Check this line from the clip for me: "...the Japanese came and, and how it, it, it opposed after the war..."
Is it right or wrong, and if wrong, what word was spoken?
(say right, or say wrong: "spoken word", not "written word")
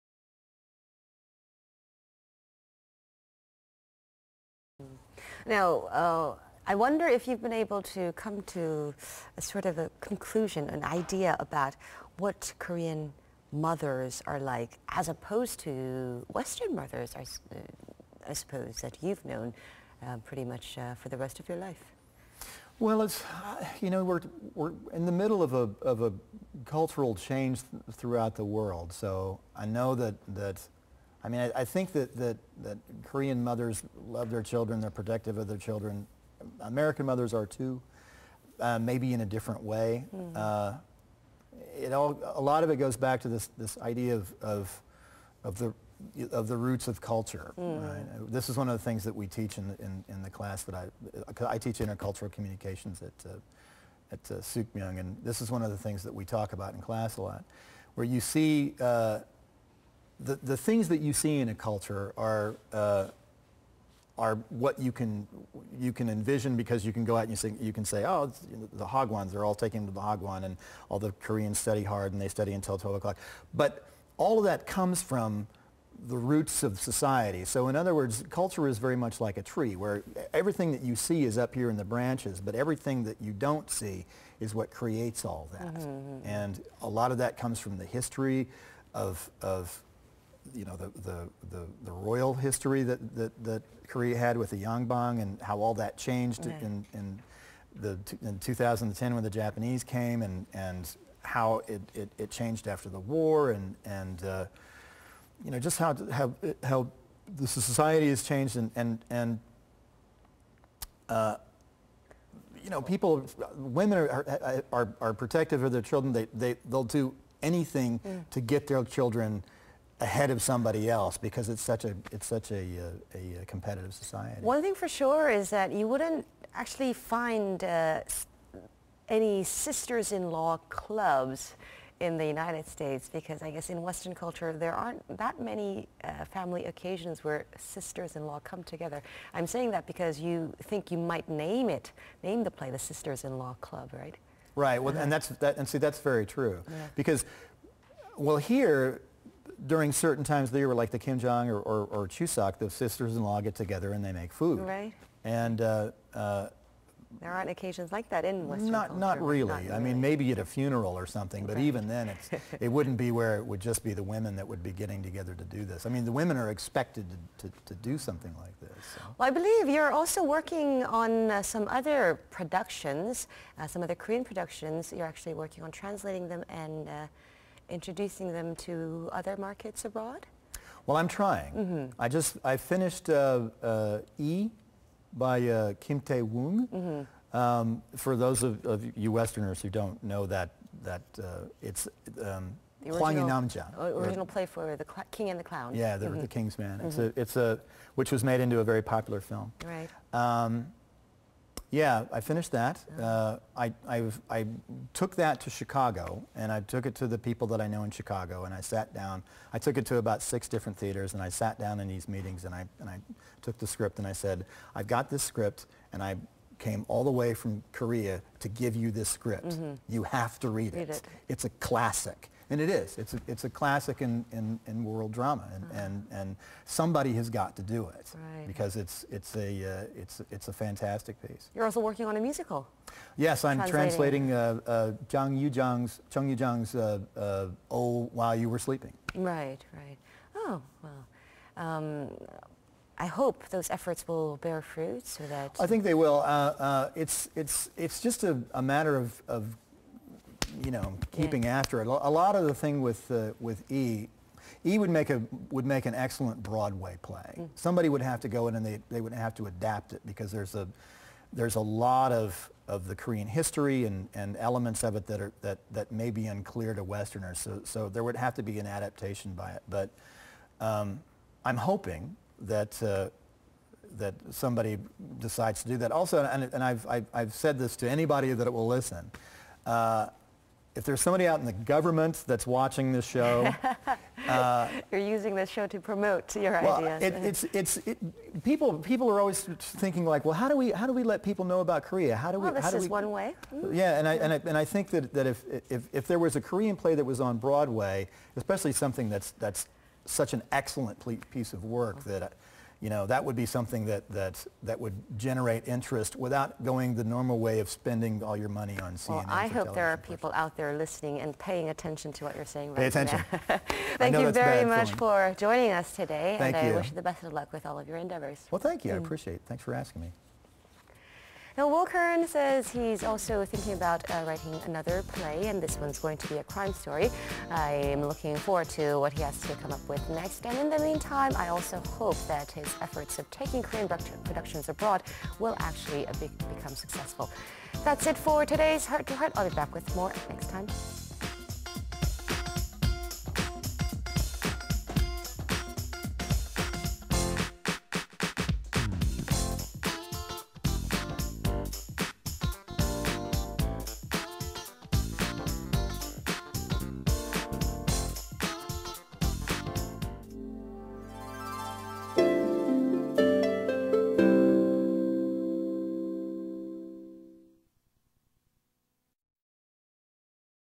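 wrong: "changed", not "opposed".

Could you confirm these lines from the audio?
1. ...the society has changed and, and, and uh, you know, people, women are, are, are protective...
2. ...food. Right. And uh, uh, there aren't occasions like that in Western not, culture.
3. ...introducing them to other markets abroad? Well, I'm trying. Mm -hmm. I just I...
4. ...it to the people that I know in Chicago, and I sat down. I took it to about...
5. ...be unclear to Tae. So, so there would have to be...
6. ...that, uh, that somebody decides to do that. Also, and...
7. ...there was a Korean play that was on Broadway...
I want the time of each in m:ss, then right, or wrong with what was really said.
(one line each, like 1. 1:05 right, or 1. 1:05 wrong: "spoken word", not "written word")
1. 1:47 right
2. 2:34 right
3. 2:57 right
4. 3:26 right
5. 4:26 wrong: "Westerners", not "Tae"
6. 4:32 right
7. 4:56 right.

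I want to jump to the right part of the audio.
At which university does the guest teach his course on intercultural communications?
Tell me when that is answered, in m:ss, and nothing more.
0:54.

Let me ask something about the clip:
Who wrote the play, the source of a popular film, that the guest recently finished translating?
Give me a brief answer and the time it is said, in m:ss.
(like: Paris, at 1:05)
Kim Tae Woong, at 3:05.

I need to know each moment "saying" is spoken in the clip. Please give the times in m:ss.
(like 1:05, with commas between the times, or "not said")
2:19, 5:12.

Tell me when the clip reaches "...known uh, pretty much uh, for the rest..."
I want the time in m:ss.
0:19.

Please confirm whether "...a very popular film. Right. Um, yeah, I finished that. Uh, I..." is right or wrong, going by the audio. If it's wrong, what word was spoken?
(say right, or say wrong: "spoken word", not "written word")
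right.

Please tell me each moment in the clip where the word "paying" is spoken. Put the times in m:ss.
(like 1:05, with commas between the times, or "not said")
5:11.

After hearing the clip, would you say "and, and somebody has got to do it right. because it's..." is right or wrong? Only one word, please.
right.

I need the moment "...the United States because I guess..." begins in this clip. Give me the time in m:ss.
2:12.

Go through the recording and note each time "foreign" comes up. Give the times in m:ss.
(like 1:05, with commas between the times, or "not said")
not said.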